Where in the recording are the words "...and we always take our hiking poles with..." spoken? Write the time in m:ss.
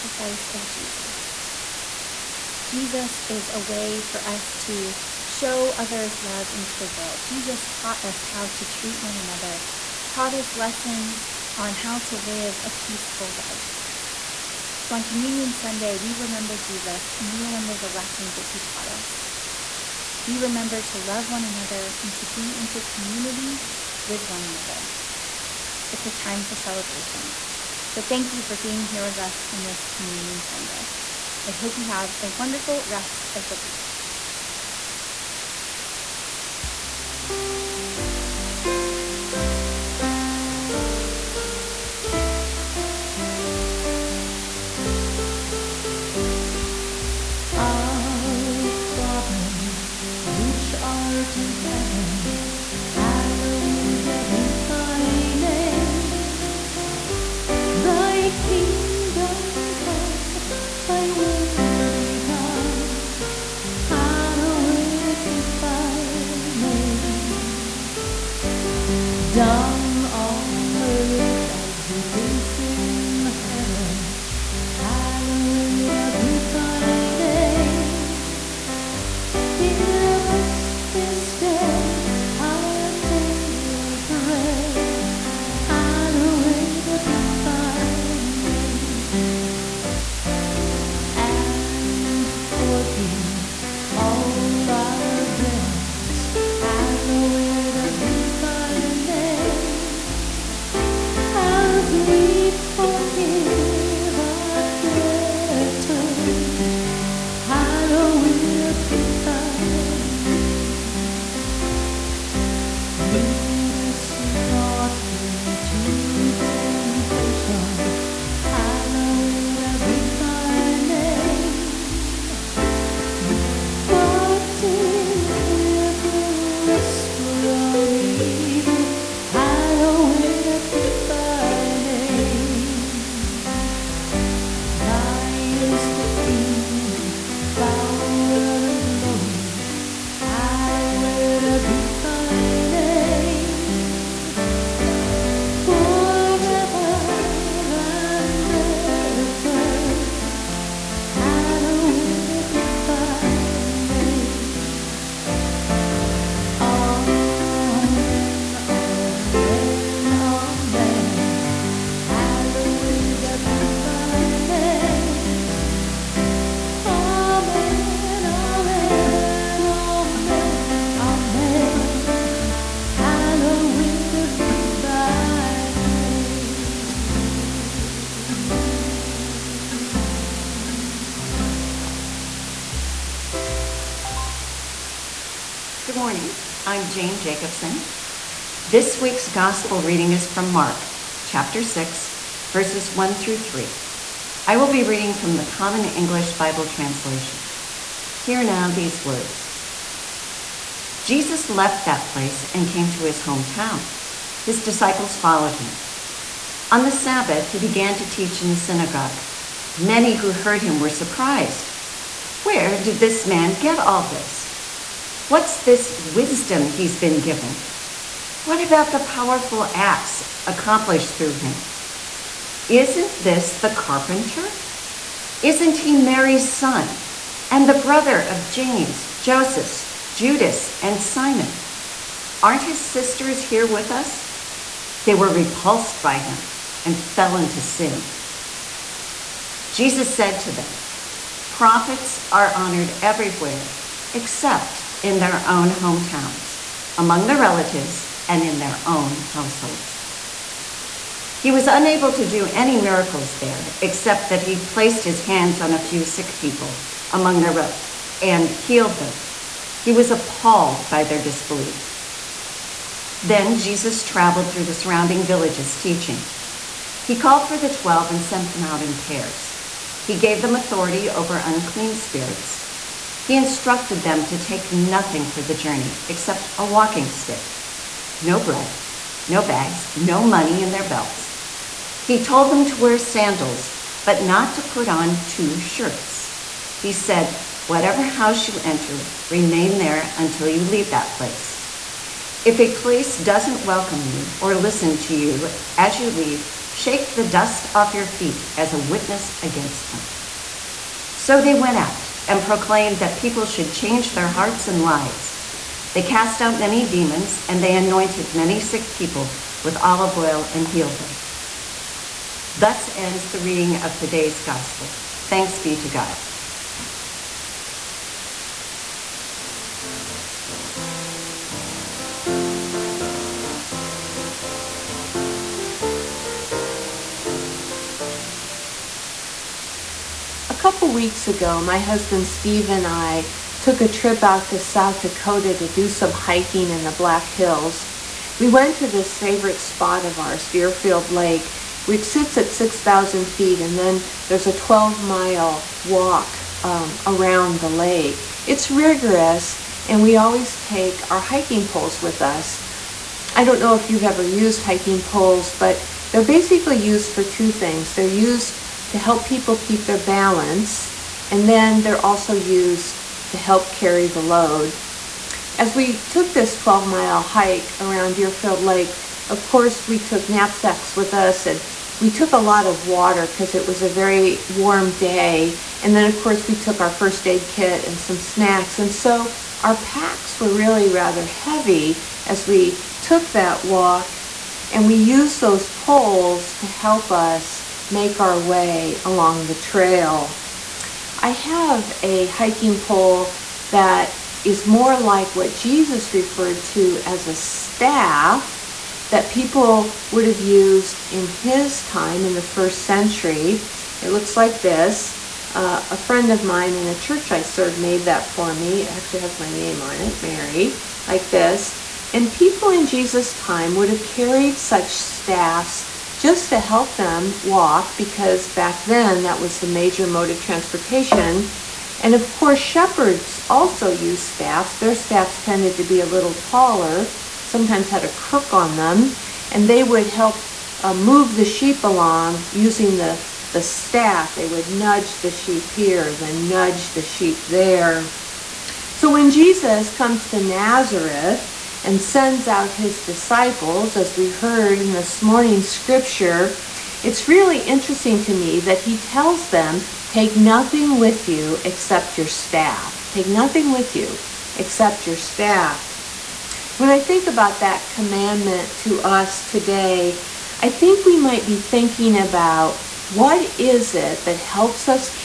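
5:49.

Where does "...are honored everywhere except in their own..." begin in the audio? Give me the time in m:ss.
4:02.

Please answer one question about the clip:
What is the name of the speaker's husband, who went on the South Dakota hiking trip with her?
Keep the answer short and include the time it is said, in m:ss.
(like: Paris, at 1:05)
Steve, at 5:32.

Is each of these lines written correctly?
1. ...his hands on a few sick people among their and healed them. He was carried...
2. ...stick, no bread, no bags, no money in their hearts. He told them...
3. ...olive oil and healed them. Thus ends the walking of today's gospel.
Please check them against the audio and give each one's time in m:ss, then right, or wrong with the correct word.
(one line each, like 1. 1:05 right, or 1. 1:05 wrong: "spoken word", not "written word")
1. 4:15 wrong: "appalled", not "carried"
2. 4:37 wrong: "belts", not "hearts"
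3. 5:09 wrong: "reading", not "walking".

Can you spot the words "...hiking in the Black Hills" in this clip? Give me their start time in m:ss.
5:36.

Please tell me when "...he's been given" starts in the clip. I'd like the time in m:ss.
3:36.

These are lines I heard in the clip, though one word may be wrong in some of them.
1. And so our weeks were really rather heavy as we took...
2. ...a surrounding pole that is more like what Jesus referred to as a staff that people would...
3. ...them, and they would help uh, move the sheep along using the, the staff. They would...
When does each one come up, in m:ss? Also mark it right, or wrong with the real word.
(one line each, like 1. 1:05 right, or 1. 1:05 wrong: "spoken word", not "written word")
1. 6:18 wrong: "packs", not "weeks"
2. 6:32 wrong: "hiking", not "surrounding"
3. 7:08 right.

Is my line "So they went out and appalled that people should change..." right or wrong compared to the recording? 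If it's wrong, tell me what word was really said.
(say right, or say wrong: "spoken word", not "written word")
wrong: "proclaimed", not "appalled".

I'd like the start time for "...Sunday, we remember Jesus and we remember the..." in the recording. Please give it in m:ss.
0:15.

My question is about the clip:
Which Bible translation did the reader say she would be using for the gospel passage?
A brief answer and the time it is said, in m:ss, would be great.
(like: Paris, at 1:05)
Common English Bible, at 3:15.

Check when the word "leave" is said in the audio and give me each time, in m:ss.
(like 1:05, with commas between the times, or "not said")
4:50, 4:56.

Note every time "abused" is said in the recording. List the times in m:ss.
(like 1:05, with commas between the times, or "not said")
not said.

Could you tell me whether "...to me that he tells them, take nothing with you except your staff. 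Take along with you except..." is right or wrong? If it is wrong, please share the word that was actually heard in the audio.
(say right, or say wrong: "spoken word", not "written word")
wrong: "nothing", not "along".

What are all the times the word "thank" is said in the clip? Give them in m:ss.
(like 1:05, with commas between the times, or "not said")
0:28, 5:15.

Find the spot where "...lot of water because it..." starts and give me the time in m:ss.
6:12.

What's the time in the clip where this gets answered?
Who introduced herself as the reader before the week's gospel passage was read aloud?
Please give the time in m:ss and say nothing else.
3:06.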